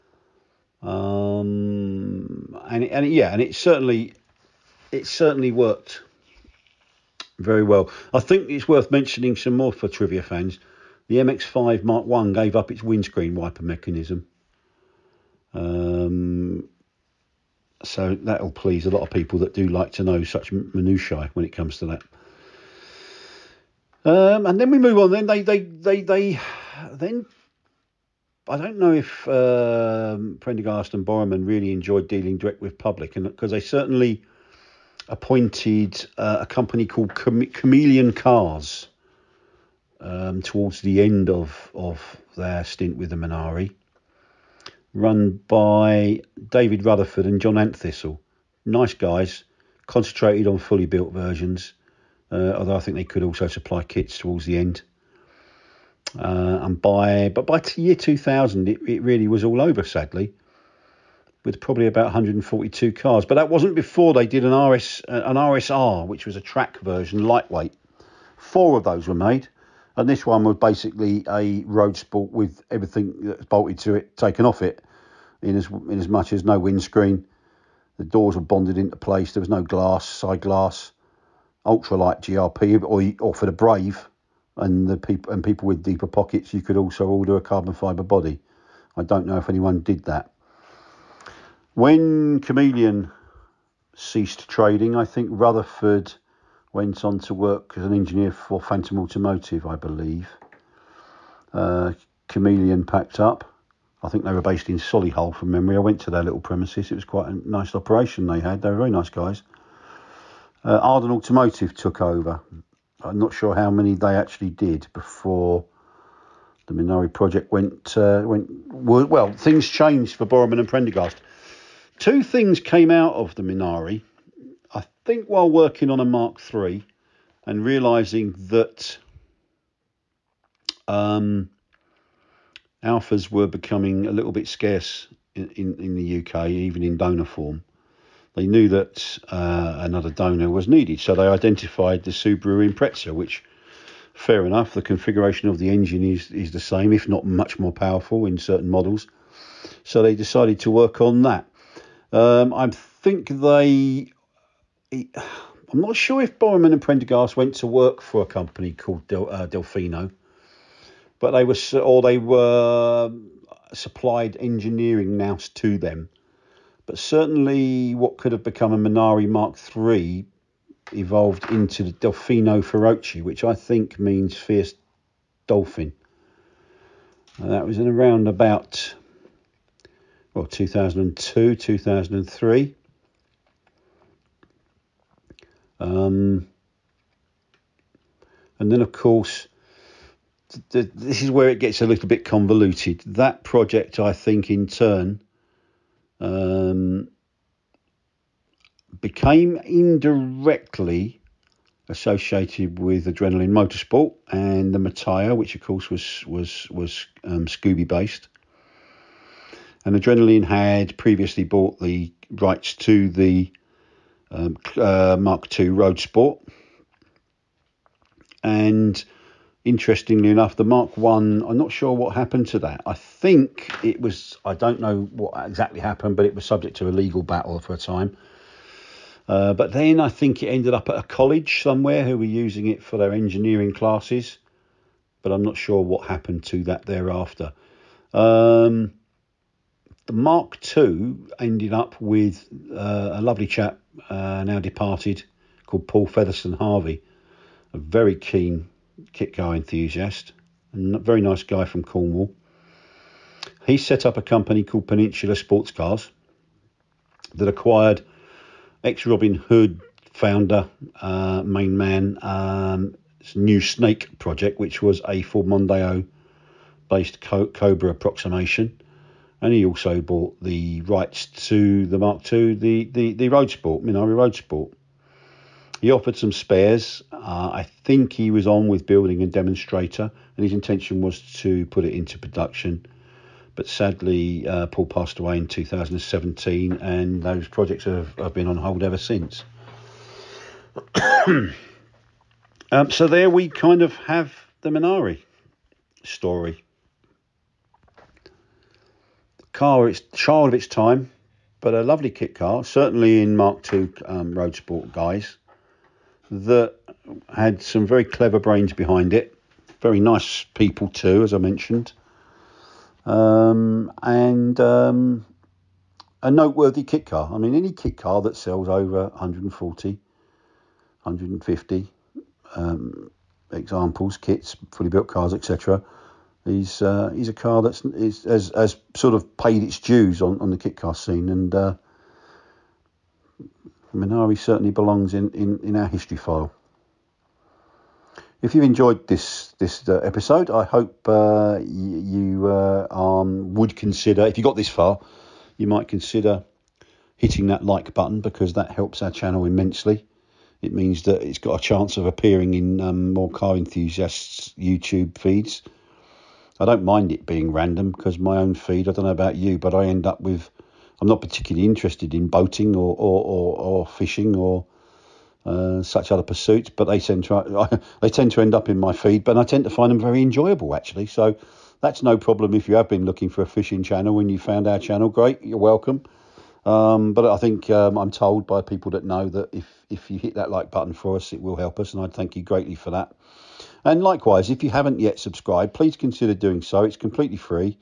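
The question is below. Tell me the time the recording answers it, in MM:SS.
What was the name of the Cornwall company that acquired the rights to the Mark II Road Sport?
04:14.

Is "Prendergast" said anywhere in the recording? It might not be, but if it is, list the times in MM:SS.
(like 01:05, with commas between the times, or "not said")
00:30, 02:00, 02:36.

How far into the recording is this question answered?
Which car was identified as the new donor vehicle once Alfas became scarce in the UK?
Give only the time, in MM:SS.
02:22.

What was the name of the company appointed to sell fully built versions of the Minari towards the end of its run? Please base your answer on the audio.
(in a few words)
Chameleon Cars.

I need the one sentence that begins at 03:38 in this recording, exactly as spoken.
And interestingly enough, the Mark One, I'm not sure what happened to that.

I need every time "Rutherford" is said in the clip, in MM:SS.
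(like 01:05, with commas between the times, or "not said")
00:46, 01:35.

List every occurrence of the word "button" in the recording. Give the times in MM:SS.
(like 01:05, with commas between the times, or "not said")
05:47, 06:20.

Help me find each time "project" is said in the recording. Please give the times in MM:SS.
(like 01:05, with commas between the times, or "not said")
01:57, 03:13, 04:24, 04:47.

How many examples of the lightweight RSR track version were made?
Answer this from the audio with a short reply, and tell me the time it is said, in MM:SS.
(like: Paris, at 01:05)
4, at 01:08.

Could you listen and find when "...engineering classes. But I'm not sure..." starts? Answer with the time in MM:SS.
03:53.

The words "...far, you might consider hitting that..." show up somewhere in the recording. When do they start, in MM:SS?
05:44.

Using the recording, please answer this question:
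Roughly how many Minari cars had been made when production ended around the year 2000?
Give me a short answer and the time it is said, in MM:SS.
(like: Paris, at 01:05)
142, at 01:02.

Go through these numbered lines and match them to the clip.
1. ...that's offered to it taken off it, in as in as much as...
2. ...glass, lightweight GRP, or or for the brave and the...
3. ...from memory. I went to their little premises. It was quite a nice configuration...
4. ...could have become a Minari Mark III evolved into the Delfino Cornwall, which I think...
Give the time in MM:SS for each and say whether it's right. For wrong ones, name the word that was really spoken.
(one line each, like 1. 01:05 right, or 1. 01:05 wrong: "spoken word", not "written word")
1. 01:13 wrong: "bolted", not "offered"
2. 01:20 wrong: "ultralight", not "lightweight"
3. 01:45 wrong: "operation", not "configuration"
4. 02:48 wrong: "Feroce", not "Cornwall".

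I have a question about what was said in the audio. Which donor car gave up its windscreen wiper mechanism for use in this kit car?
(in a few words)
MX5 Mark 1.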